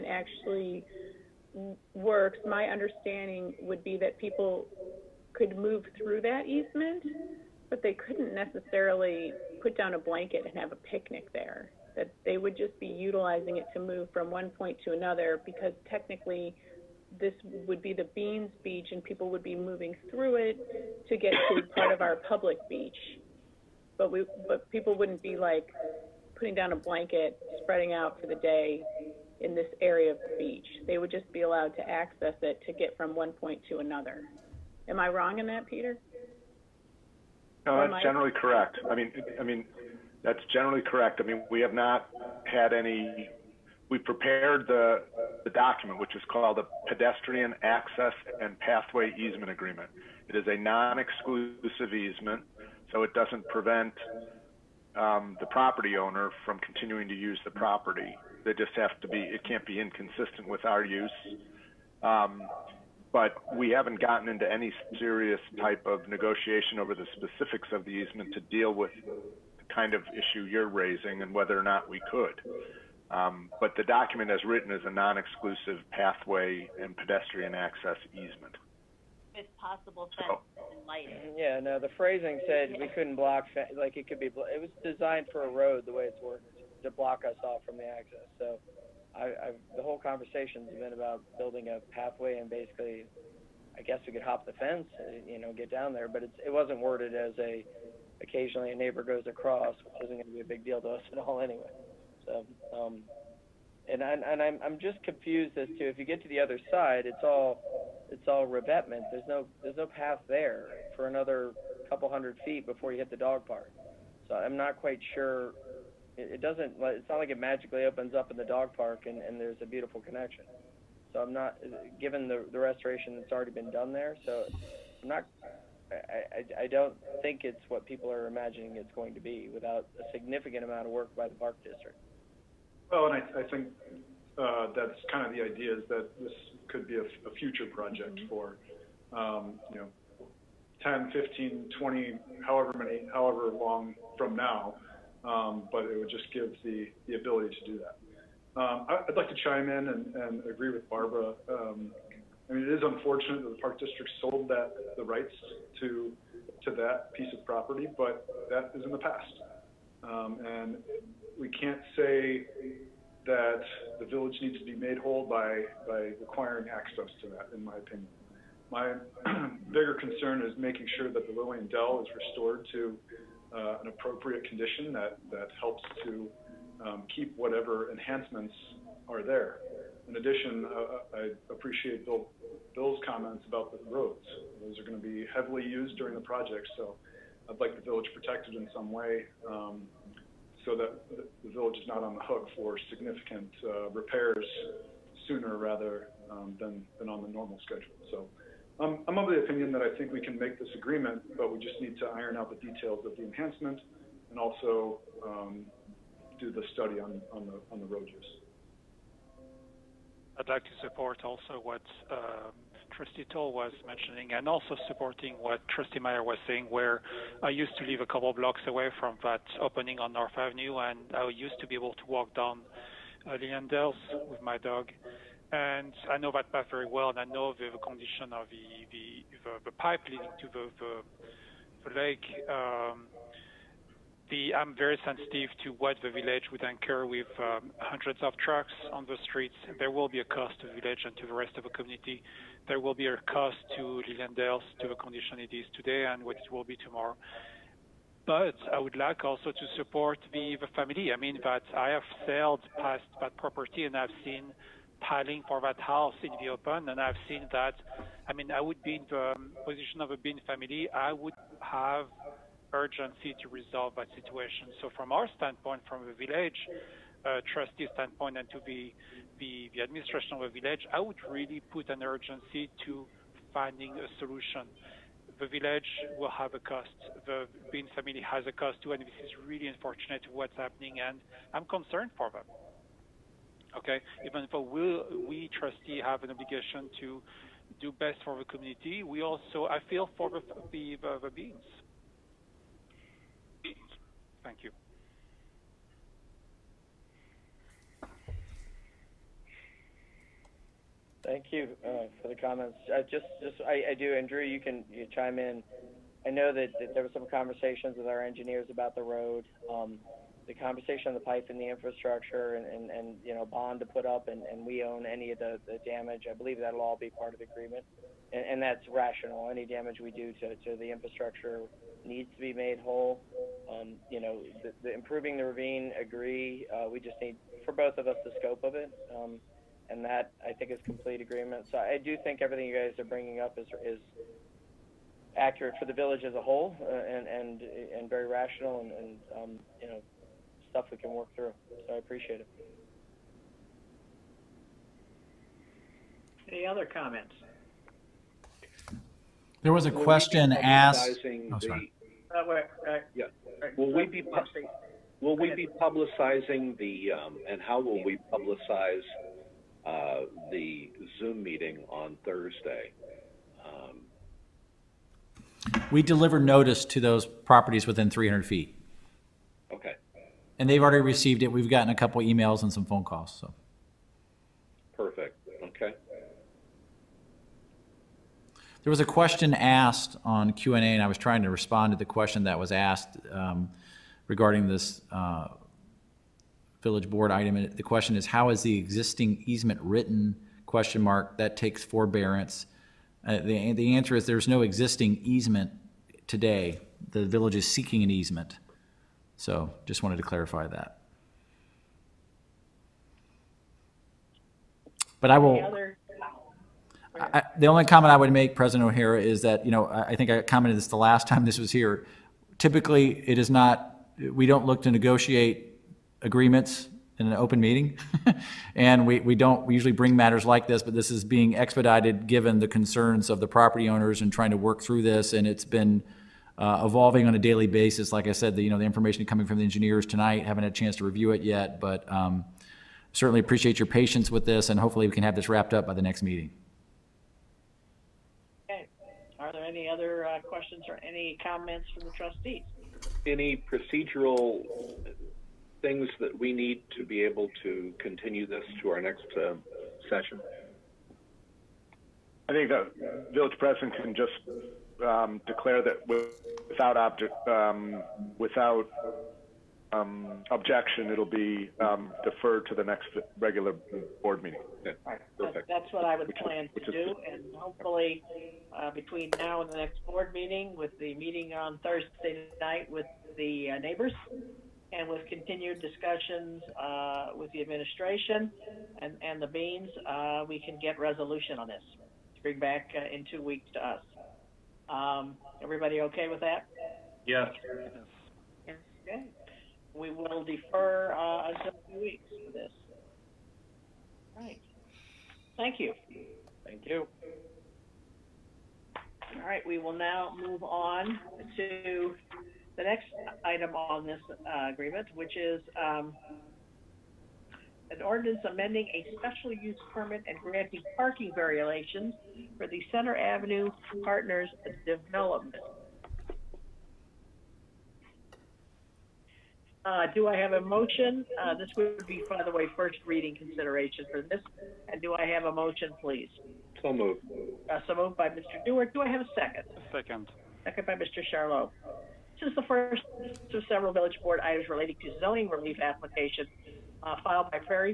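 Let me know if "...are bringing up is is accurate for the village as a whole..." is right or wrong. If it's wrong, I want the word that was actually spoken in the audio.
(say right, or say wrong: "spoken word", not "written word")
right.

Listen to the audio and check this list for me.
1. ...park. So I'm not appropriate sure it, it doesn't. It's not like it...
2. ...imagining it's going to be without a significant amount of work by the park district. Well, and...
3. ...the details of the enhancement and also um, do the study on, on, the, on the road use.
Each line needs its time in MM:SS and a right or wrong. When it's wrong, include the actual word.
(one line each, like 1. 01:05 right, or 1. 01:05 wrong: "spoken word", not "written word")
1. 01:53 wrong: "quite", not "appropriate"
2. 02:08 right
3. 03:22 right.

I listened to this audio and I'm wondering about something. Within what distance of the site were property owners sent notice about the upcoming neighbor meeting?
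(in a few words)
300 feet.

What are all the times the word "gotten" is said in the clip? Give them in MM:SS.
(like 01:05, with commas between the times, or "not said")
01:04, 06:11.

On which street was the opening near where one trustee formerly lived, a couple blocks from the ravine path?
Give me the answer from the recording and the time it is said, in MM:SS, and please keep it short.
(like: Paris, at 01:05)
North Avenue, at 03:40.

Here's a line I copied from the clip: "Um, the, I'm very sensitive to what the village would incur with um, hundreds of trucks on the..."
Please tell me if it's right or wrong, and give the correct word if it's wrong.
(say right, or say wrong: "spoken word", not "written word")
right.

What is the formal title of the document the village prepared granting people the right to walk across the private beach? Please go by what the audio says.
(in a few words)
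Pedestrian Access and Pathway Easement Agreement.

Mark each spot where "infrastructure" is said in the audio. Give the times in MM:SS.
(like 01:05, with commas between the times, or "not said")
05:11, 05:20.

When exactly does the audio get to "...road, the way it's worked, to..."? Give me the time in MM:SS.
01:25.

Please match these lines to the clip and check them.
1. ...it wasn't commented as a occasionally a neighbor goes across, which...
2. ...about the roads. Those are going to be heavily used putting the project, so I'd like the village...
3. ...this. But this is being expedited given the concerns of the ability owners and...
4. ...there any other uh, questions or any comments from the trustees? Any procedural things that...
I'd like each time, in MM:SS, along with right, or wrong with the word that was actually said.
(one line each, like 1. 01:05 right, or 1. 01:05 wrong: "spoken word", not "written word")
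1. 01:36 wrong: "worded", not "commented"
2. 03:03 wrong: "during", not "putting"
3. 07:00 wrong: "property", not "ability"
4. 07:19 right.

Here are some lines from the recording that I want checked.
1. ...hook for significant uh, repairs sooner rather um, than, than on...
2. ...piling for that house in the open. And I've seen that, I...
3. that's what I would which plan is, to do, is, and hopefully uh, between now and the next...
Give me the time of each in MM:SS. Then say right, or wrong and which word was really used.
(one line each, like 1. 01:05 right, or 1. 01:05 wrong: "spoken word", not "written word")
1. 03:12 right
2. 04:15 right
3. 07:45 right.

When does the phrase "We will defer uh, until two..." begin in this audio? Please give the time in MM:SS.
08:09.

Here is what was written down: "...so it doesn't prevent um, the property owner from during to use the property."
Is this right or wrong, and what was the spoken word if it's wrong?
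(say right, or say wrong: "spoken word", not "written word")
wrong: "continuing", not "during".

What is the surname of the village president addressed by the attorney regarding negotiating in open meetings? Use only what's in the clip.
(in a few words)
O'Hara.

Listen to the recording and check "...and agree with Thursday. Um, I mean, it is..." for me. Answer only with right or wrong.
wrong.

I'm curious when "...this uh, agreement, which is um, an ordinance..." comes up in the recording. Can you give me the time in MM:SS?
08:24.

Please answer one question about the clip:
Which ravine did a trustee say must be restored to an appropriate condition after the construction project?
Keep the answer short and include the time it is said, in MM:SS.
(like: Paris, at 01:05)
Lillian Dell, at 02:51.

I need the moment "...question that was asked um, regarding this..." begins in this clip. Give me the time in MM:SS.
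06:22.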